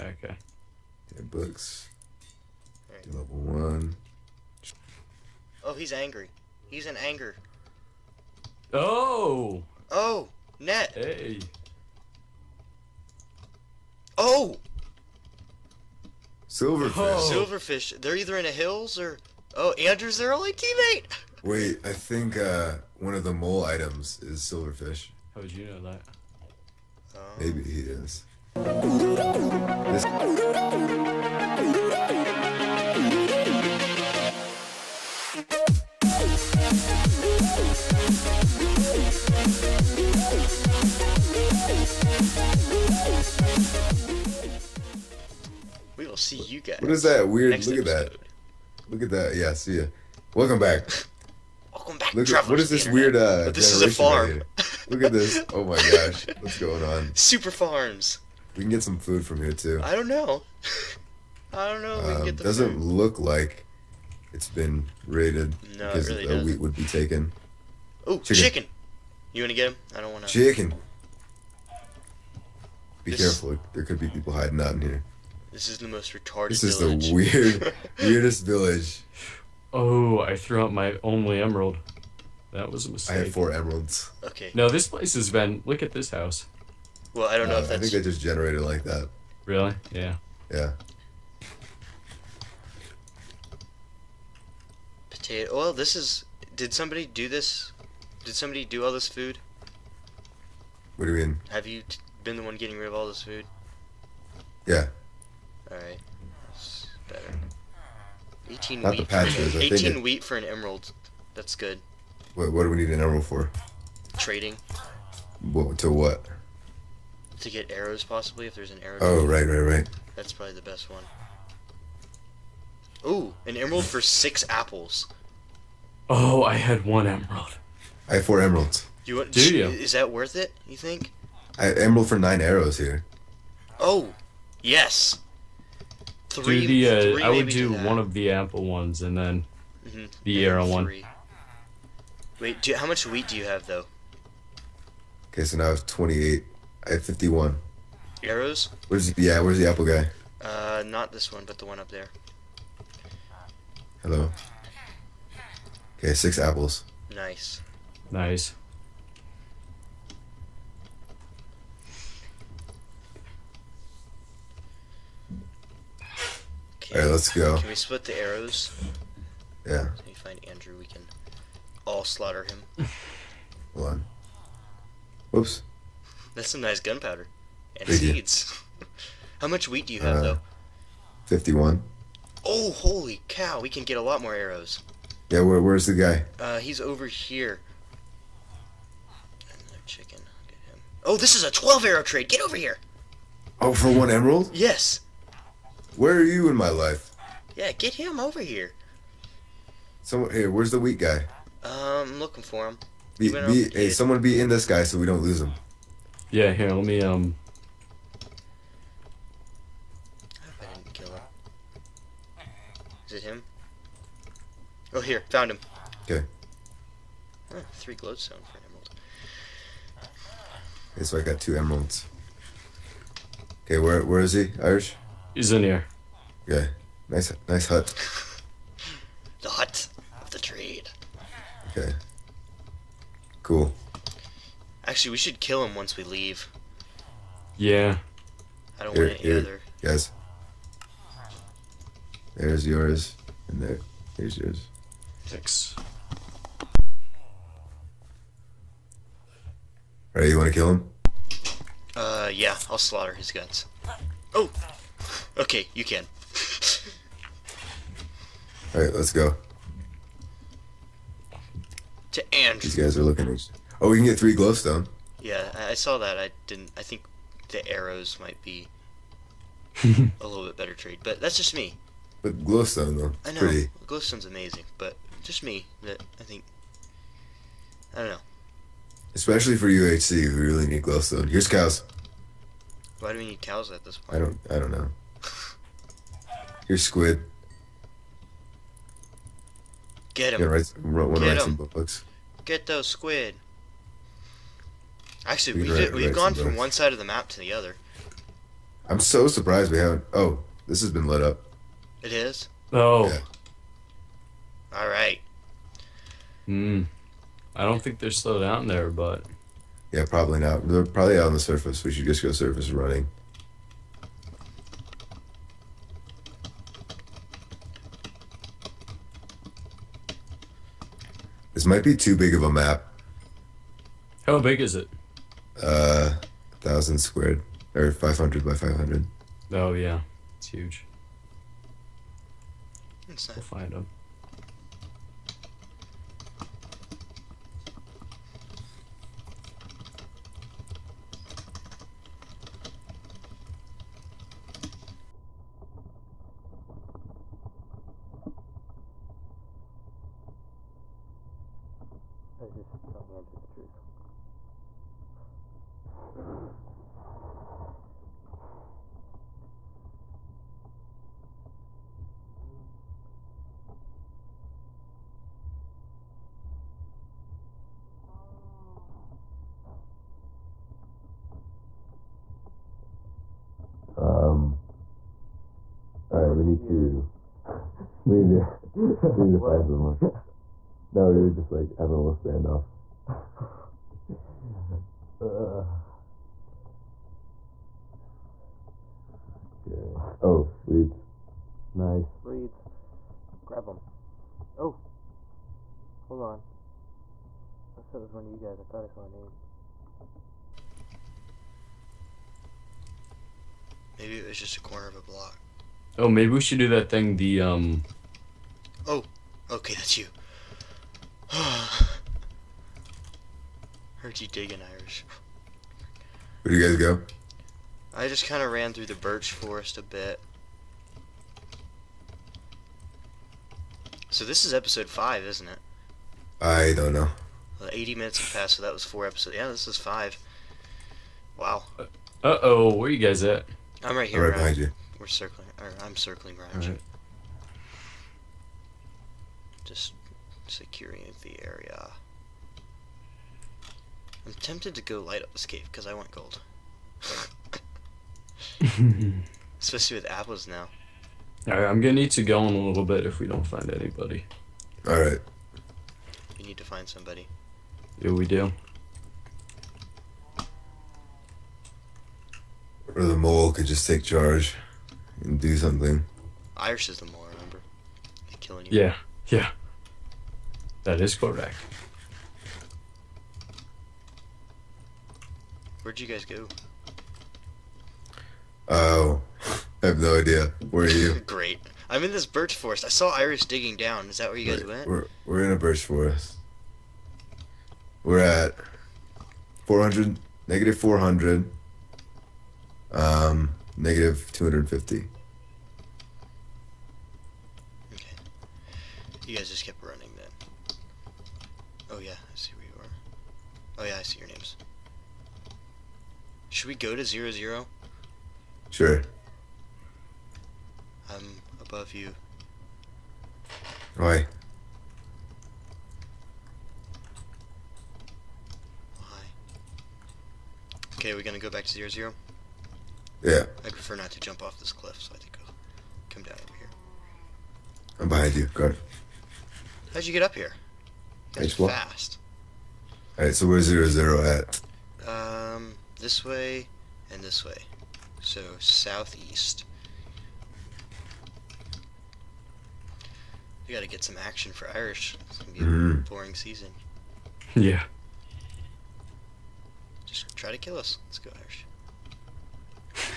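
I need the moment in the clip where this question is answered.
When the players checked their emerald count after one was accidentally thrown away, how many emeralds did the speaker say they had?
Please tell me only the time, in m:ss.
1:23.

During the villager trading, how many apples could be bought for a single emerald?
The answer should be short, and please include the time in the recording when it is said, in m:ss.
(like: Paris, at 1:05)
6, at 2:03.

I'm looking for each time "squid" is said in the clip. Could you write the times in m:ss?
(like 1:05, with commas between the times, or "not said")
4:46, 4:52.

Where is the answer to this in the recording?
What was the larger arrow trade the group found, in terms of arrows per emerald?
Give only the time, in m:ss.
3:11.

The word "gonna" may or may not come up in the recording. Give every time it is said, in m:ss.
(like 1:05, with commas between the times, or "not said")
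7:31, 8:41, 9:05.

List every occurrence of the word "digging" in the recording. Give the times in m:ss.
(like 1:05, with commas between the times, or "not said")
6:54, 8:03.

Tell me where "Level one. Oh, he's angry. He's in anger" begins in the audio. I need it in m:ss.
0:03.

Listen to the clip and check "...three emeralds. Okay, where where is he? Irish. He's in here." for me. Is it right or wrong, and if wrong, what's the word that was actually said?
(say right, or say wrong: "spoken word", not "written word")
wrong: "two", not "three".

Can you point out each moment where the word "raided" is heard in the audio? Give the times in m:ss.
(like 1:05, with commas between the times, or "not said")
1:05.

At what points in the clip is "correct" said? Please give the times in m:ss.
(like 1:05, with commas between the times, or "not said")
7:51.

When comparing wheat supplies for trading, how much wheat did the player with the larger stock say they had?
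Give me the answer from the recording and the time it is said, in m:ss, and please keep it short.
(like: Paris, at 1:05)
51, at 2:26.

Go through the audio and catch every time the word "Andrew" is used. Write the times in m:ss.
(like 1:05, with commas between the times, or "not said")
0:19, 2:50, 4:22, 5:53.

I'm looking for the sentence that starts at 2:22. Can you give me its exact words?
Wait, do, how much wheat do you have though?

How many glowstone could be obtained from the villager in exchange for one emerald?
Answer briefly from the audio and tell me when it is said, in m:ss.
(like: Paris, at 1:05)
3, at 3:37.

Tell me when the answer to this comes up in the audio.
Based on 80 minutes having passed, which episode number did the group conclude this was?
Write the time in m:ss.
7:09.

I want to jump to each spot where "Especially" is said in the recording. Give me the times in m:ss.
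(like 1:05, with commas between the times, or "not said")
4:39, 7:29.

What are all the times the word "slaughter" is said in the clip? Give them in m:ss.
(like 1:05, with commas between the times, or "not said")
2:52, 4:12.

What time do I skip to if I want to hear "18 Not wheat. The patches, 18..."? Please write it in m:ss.
1:48.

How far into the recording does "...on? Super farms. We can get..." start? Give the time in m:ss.
0:56.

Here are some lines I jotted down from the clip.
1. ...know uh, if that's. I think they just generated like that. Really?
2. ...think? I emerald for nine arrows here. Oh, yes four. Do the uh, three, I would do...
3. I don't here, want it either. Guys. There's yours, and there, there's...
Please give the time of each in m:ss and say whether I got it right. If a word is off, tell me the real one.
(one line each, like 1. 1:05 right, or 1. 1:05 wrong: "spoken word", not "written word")
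1. 1:27 right
2. 2:10 wrong: "three", not "four"
3. 3:58 right.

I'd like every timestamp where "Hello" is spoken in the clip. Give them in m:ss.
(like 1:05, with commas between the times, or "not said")
2:34.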